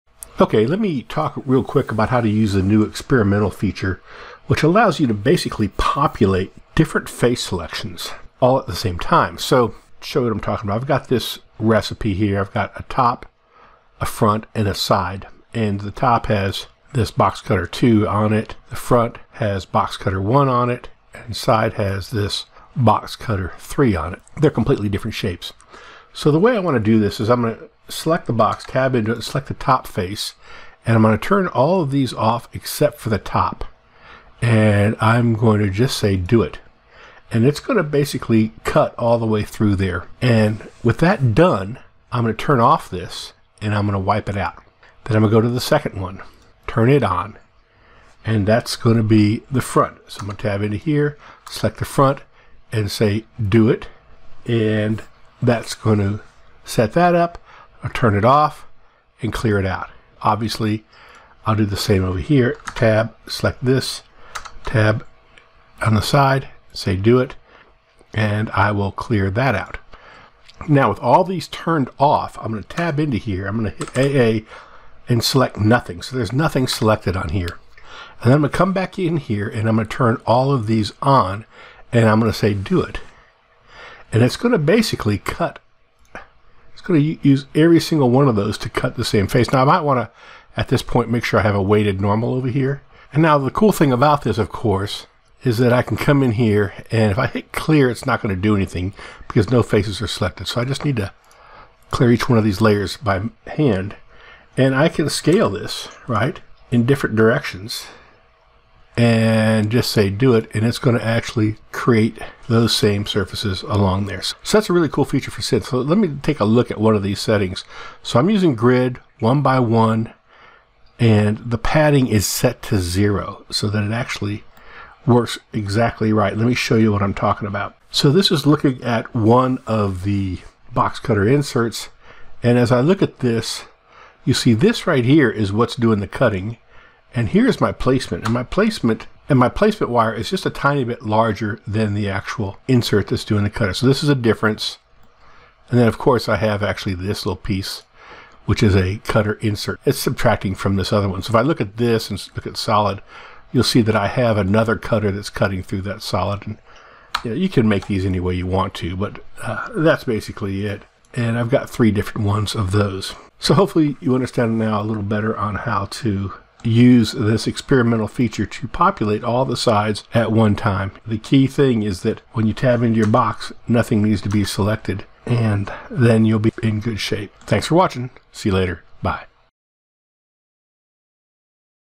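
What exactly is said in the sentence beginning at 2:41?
And I've got three different ones of those.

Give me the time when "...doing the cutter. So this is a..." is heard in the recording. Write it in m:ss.
2:23.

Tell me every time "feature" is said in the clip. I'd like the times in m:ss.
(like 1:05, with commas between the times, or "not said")
0:03, 1:55, 2:48.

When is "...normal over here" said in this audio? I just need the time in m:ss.
1:32.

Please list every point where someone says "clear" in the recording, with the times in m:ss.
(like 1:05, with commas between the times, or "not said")
0:59, 1:08, 1:37, 1:41.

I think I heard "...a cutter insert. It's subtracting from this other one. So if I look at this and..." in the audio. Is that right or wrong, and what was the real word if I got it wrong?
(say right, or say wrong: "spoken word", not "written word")
right.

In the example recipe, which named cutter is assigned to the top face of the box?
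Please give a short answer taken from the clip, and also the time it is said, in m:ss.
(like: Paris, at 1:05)
box cutter 2, at 0:17.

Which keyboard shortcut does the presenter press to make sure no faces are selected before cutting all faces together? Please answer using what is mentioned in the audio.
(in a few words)
AA.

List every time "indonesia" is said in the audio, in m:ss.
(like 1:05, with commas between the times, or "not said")
not said.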